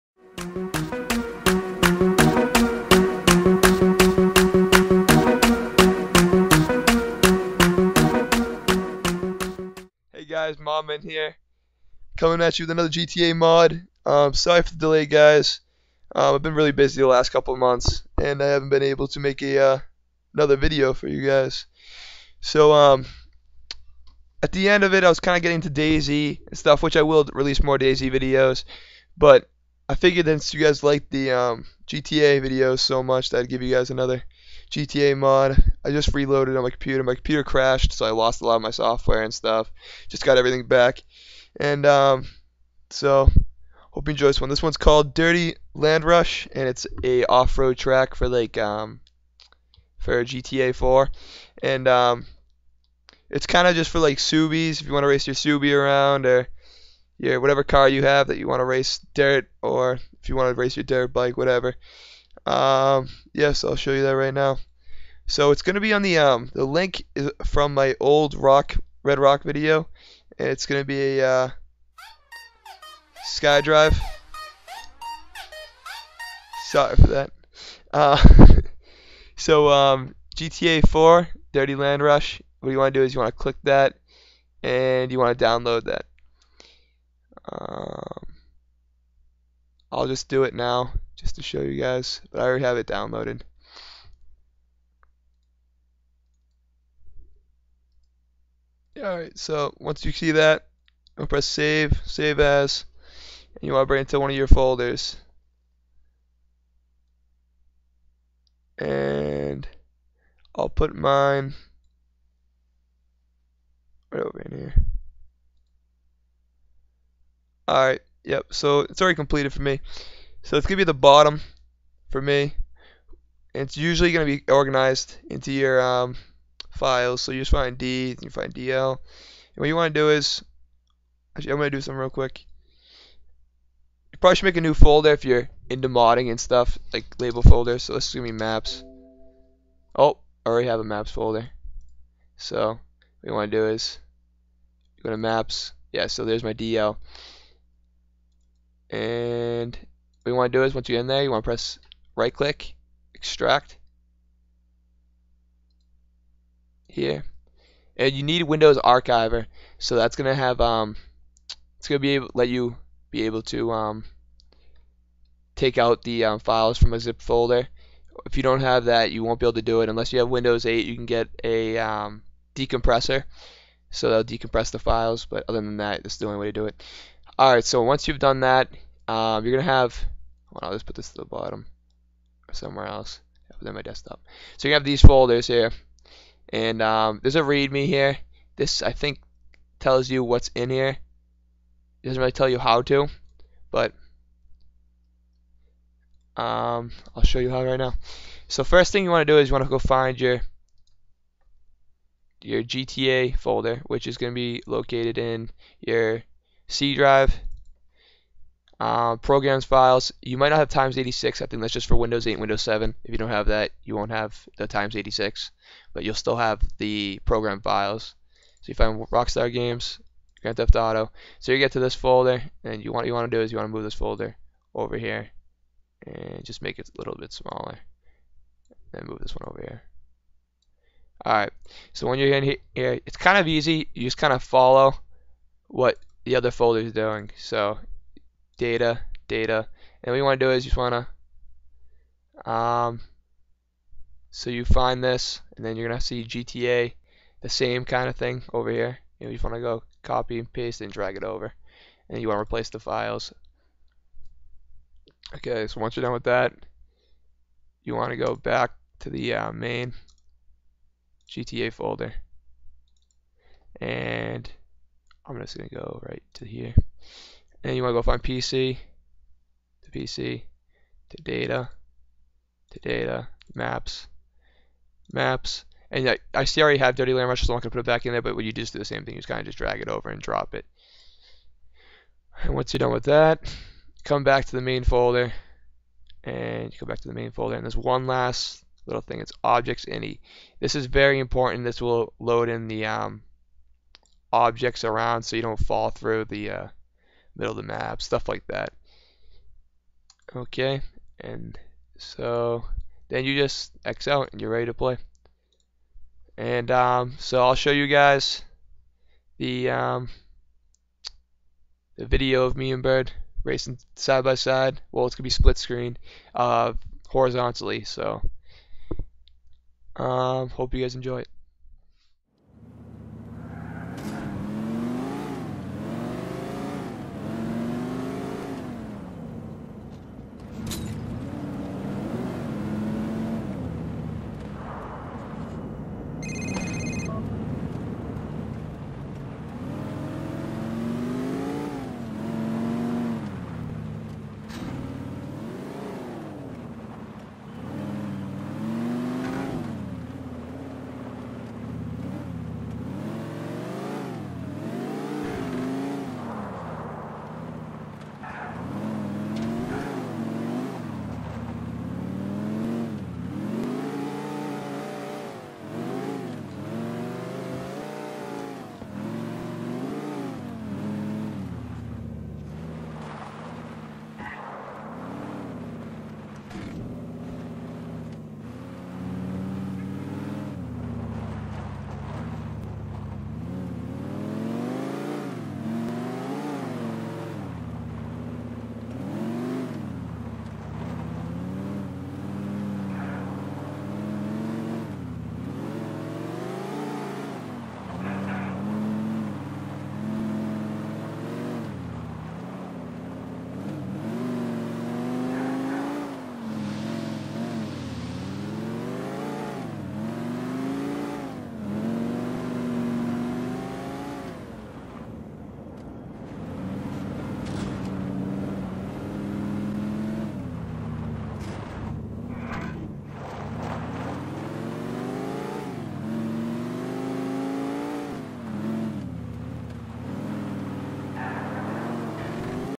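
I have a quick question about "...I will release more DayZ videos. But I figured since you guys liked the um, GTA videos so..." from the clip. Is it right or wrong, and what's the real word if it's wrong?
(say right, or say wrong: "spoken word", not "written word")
right.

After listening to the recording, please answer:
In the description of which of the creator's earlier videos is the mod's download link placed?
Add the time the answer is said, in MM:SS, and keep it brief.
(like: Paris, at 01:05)
Red Rock, at 01:09.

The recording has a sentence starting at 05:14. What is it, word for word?
Well, it's gonna be split screen, uh, horizontally.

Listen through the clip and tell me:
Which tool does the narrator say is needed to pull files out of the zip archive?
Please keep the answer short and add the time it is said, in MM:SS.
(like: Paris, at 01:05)
Windows Archiver, at 02:38.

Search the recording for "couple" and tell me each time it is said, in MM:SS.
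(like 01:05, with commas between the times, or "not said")
00:17.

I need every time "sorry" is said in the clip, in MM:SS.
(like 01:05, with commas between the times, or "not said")
00:14, 01:16.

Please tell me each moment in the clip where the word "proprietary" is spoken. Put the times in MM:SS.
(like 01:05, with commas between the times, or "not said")
not said.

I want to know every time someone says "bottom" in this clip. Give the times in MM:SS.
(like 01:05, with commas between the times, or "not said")
02:00, 03:01.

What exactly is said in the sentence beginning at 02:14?
You probably should make a new folder if you're into modding and stuff, like label folder.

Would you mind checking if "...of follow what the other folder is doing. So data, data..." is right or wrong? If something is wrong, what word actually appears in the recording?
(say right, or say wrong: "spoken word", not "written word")
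right.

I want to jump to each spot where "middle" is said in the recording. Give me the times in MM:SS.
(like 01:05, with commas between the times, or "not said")
04:57.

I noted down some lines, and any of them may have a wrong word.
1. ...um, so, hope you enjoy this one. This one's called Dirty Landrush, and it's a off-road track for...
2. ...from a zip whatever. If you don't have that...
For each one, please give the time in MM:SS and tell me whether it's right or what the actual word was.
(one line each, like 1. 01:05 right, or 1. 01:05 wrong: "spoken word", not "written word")
1. 00:41 right
2. 02:46 wrong: "folder", not "whatever".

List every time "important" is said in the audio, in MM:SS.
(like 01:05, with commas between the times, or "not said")
04:51.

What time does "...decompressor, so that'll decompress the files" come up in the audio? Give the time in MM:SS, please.
02:52.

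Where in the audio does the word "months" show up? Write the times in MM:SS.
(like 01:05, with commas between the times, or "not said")
00:17.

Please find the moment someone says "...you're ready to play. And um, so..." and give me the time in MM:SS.
05:04.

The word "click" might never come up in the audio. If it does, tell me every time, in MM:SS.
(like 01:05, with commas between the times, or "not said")
01:23, 02:32.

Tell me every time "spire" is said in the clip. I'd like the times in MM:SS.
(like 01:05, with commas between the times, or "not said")
not said.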